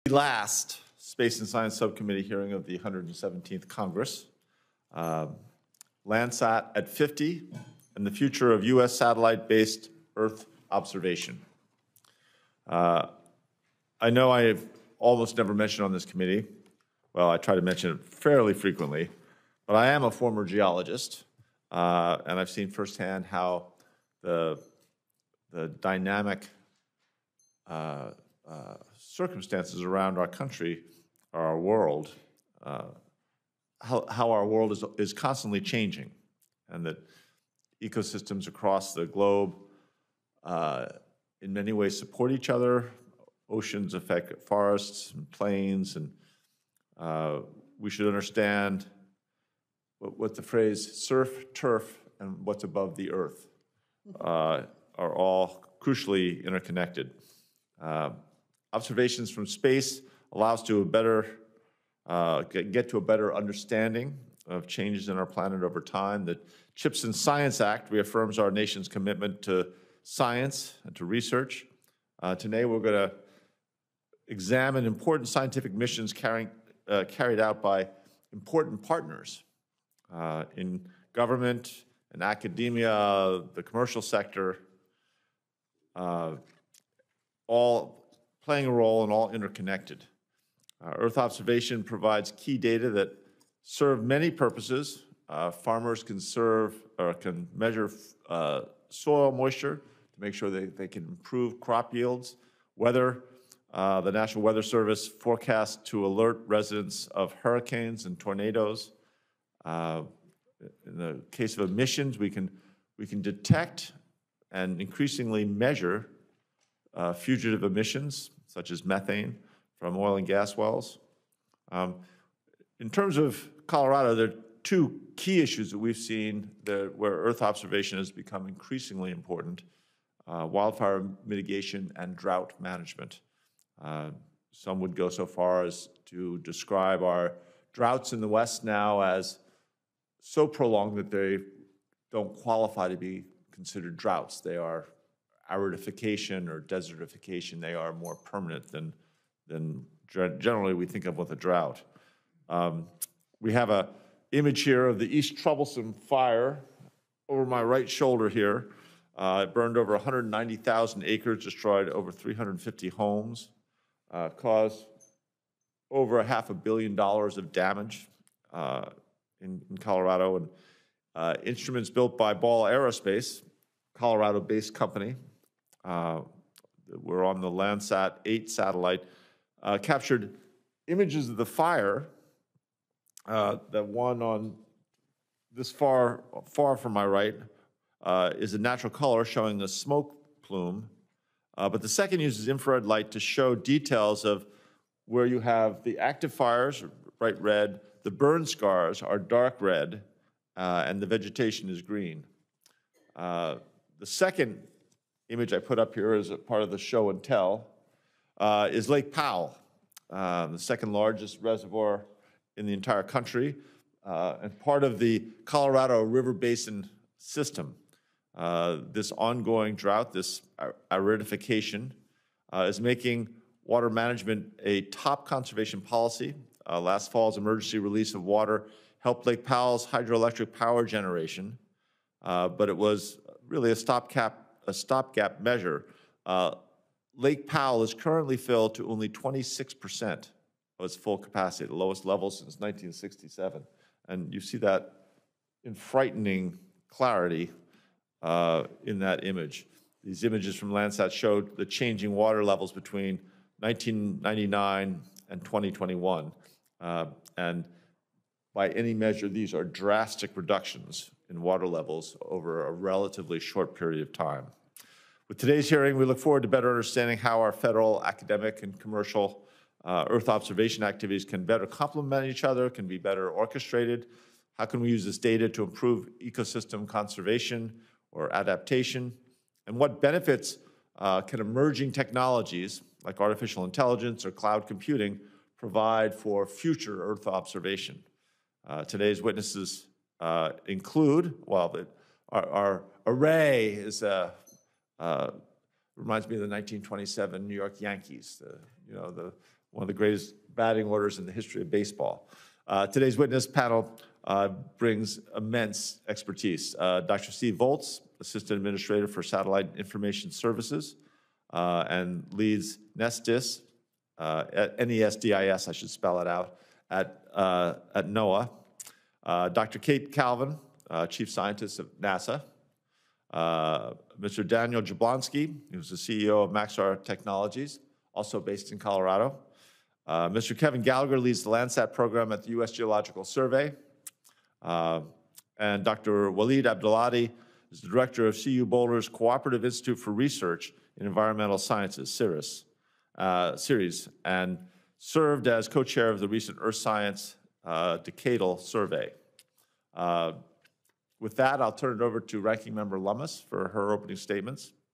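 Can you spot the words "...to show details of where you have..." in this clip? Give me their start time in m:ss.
3:13.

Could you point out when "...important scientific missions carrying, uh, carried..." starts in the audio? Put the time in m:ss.
1:14.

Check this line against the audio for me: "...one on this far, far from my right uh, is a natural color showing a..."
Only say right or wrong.
right.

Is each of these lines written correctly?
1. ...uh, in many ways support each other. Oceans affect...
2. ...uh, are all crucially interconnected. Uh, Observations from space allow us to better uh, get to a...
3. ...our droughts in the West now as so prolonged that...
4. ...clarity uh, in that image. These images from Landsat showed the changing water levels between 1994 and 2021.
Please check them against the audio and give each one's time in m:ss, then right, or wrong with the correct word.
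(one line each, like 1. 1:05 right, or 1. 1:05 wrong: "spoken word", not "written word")
1. 0:40 right
2. 0:54 right
3. 2:17 right
4. 4:06 wrong: "1999", not "1994".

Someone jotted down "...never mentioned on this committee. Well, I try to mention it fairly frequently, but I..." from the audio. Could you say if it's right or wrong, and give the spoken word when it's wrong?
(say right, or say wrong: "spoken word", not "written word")
right.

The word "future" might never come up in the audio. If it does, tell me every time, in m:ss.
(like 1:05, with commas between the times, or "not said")
0:08, 4:46.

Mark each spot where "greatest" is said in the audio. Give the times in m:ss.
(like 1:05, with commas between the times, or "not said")
4:59.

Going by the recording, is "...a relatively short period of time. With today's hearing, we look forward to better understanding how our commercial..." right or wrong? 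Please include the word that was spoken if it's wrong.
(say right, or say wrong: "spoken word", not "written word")
wrong: "federal", not "commercial".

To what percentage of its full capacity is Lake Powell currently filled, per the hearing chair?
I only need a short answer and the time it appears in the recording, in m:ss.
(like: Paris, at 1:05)
26%, at 3:59.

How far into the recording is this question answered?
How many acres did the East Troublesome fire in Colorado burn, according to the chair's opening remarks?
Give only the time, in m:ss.
2:39.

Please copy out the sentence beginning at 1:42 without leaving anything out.
Weather, uh, the National Weather Service forecasts to alert residents of hurricanes and tornadoes.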